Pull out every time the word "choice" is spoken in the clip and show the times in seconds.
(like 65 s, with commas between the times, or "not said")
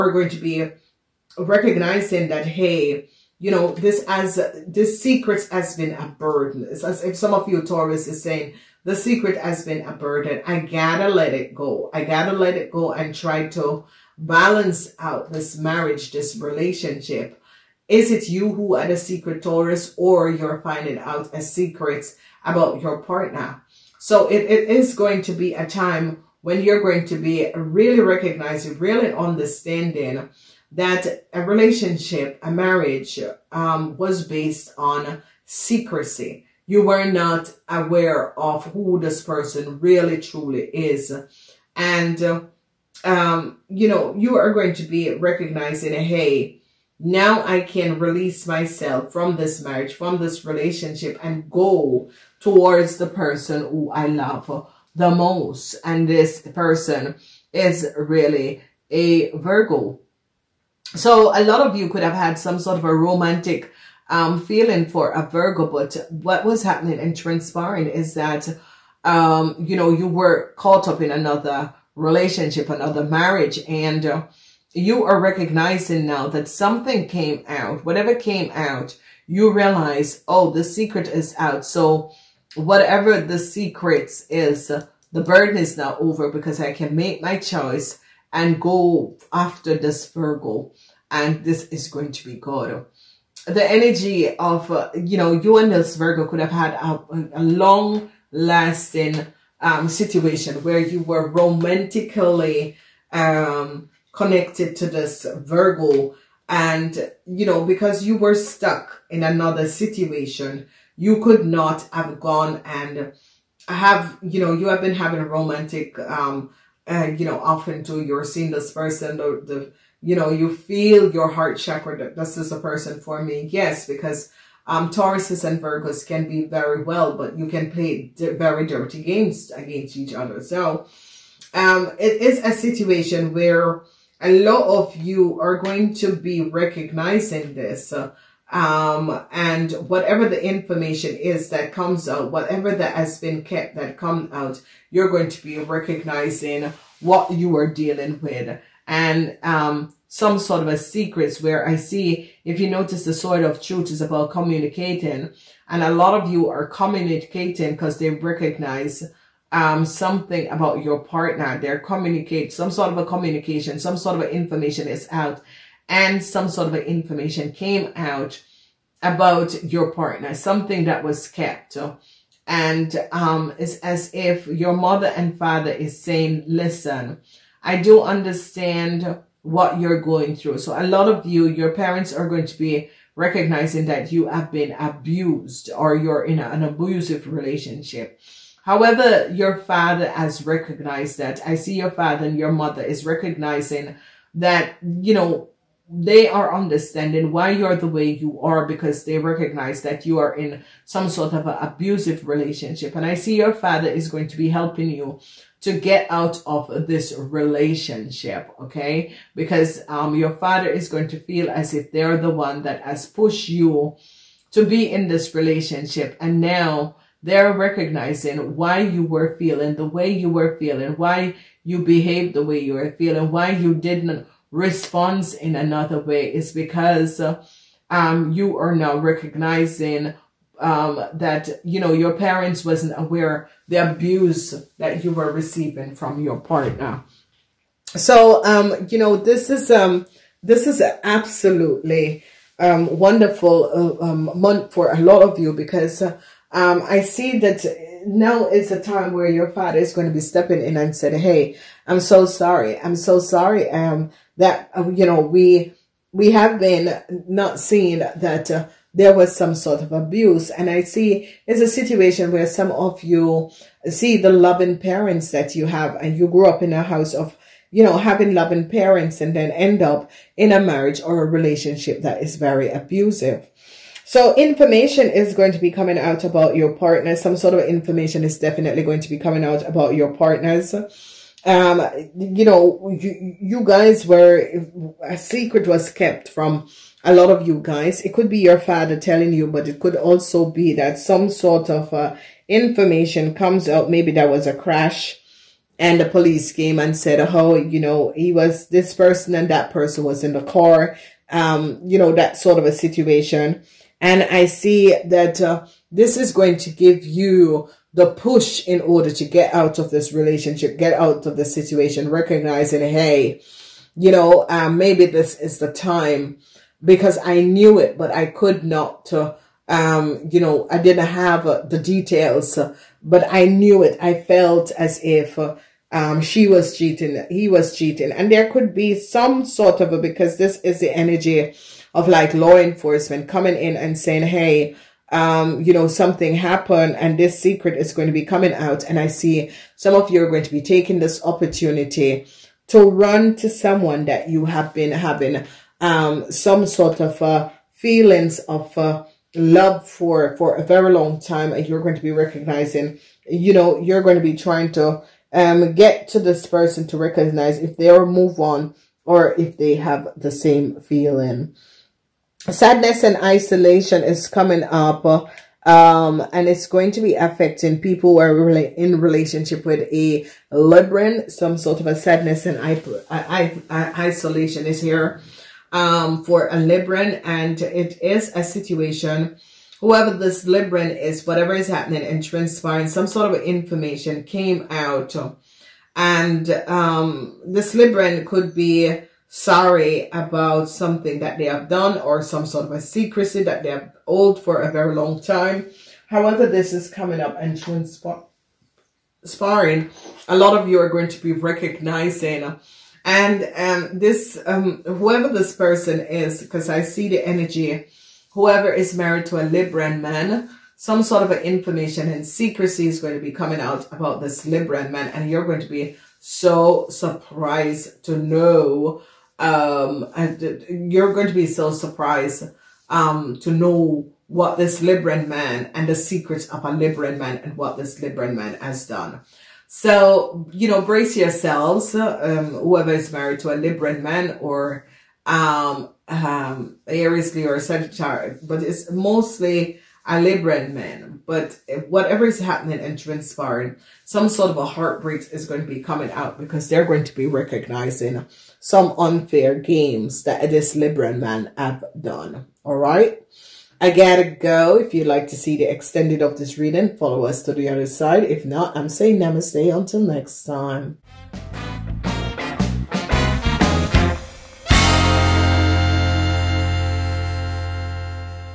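87 s.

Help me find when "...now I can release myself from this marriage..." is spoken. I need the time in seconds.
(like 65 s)
46 s.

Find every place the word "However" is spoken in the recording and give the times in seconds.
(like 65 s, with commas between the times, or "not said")
188 s, 396 s.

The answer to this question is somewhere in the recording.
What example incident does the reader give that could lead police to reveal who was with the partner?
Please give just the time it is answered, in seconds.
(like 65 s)
294 s.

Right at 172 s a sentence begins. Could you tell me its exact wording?
And um, it's as if your mother and father is saying, listen, I do understand what you're going through.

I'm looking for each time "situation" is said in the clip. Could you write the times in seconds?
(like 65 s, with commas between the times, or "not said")
99 s, 109 s, 132 s, 261 s, 302 s, 311 s, 378 s.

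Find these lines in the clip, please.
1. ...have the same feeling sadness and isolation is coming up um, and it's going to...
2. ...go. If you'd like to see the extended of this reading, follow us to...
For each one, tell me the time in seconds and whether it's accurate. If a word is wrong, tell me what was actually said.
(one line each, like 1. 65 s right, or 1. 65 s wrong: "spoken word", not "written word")
1. 359 s right
2. 454 s right.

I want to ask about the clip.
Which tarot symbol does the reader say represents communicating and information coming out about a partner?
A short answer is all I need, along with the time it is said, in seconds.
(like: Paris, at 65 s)
sword of truth, at 153 s.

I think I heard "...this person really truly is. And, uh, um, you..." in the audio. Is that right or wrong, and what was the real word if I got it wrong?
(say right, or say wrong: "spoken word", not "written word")
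right.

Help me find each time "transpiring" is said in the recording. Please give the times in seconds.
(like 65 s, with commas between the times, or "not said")
67 s, 382 s, 442 s.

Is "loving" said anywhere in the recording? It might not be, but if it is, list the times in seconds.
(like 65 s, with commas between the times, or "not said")
264 s, 268 s.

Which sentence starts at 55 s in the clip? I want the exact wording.
And this person is really a Virgo.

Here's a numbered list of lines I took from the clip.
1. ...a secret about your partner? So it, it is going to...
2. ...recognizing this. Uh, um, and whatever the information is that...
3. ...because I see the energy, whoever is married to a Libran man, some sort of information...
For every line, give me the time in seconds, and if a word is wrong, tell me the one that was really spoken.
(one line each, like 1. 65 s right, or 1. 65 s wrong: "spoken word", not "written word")
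1. 21 s right
2. 136 s right
3. 406 s right.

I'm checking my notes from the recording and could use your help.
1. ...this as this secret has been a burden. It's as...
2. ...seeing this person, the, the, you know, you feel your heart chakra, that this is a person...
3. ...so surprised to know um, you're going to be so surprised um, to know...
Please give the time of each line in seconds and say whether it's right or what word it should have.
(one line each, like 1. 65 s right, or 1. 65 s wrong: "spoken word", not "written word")
1. 3 s right
2. 118 s right
3. 416 s right.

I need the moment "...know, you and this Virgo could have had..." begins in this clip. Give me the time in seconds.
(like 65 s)
95 s.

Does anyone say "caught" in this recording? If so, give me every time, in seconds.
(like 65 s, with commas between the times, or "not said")
70 s.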